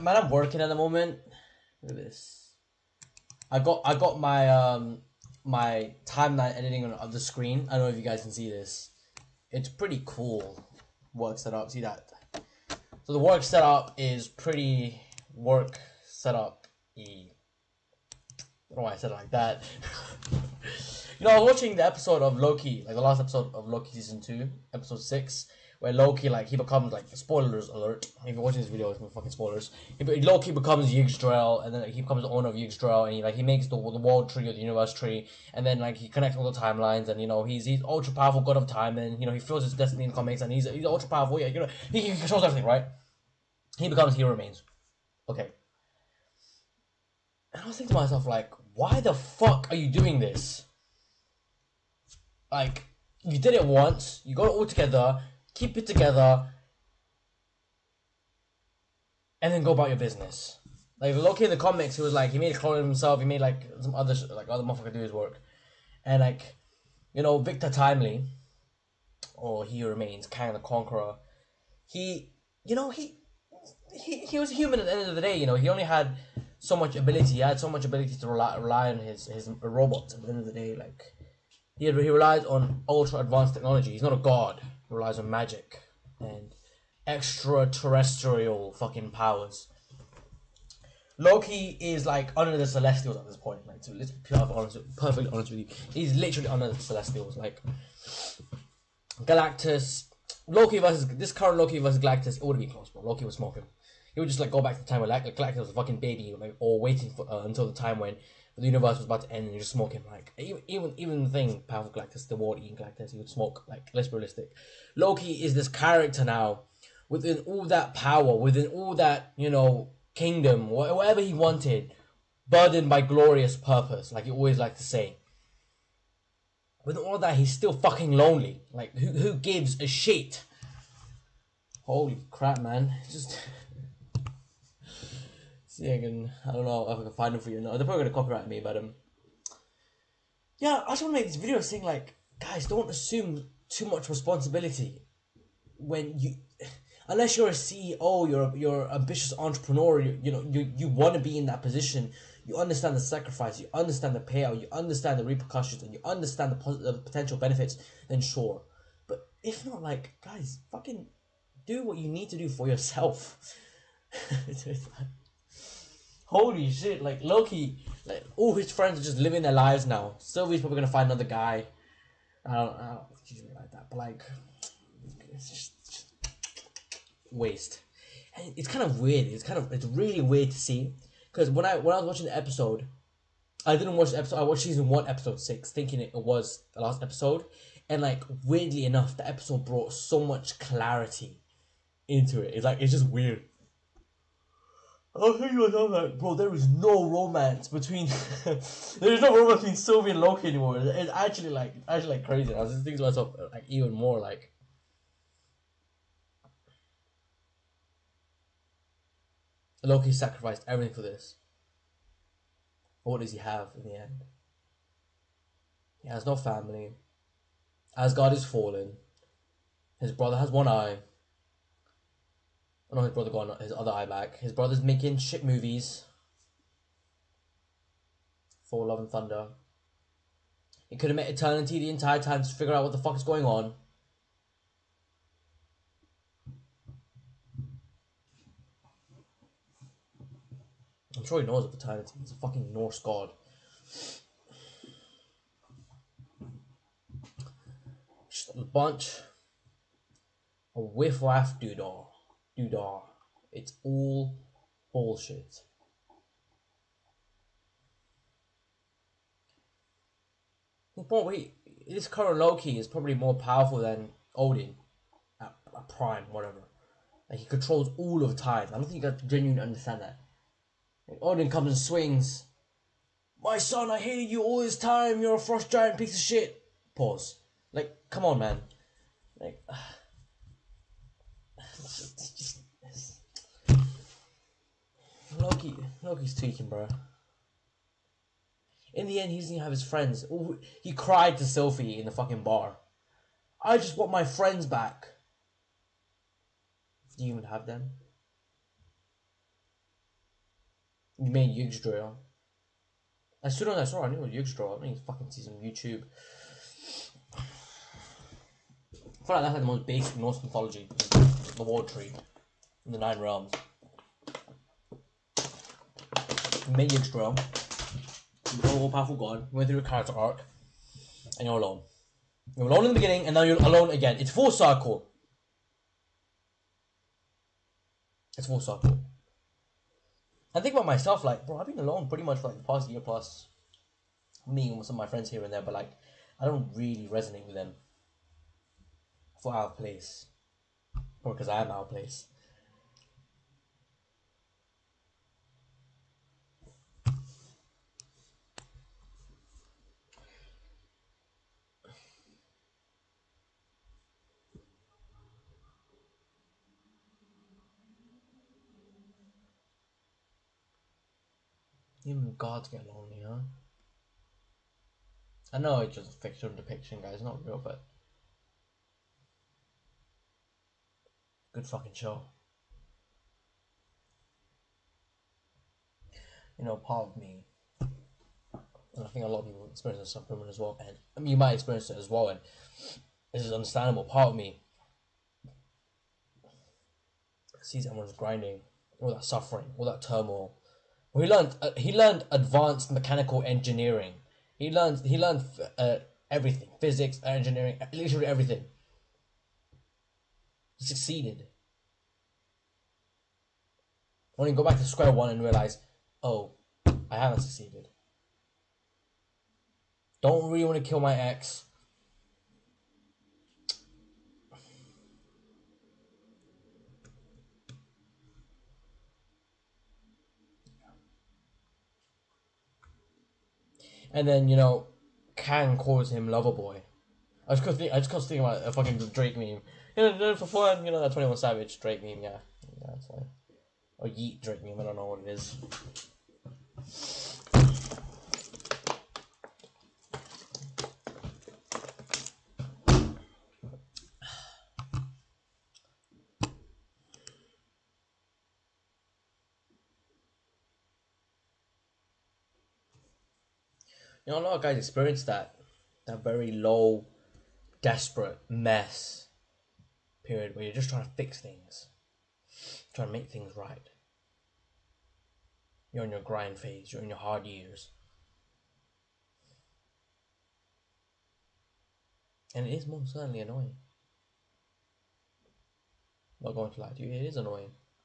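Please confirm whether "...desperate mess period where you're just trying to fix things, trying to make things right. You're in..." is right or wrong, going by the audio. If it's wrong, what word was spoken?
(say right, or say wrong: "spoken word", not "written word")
right.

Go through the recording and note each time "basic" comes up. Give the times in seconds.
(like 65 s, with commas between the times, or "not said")
309 s.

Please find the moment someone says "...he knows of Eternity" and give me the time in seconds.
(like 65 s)
241 s.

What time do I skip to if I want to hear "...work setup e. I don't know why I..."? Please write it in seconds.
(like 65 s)
15 s.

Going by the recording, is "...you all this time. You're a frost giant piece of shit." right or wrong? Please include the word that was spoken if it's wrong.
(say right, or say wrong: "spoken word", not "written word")
right.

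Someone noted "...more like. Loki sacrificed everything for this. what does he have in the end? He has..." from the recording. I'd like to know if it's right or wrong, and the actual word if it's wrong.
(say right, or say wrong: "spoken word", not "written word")
right.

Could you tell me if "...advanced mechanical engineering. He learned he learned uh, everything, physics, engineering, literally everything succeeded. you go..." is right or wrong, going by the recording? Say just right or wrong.
right.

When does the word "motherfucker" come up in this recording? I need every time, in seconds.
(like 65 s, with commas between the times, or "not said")
64 s.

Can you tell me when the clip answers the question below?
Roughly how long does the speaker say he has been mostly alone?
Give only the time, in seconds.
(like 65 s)
332 s.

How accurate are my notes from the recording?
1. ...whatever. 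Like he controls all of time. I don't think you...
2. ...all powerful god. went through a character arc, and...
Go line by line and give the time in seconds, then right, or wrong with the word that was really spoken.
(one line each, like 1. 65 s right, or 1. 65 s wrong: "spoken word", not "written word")
1. 266 s right
2. 318 s right.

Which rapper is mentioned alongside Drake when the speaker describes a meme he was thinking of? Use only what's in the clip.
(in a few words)
21 Savage.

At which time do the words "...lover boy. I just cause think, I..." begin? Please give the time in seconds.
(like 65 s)
426 s.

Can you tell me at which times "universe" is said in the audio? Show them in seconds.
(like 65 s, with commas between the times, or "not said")
34 s, 108 s.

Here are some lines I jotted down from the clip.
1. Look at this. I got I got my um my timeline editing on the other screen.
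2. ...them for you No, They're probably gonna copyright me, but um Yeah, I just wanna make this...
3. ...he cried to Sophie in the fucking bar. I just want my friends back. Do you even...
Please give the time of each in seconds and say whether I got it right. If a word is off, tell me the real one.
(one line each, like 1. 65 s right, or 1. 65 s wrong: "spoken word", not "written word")
1. 1 s right
2. 137 s right
3. 290 s right.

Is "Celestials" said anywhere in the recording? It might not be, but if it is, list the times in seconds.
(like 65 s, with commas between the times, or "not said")
92 s, 96 s.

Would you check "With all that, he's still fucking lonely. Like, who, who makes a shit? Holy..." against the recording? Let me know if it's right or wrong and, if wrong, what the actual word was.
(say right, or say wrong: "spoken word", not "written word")
wrong: "gives", not "makes".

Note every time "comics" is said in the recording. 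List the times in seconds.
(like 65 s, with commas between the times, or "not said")
40 s, 61 s.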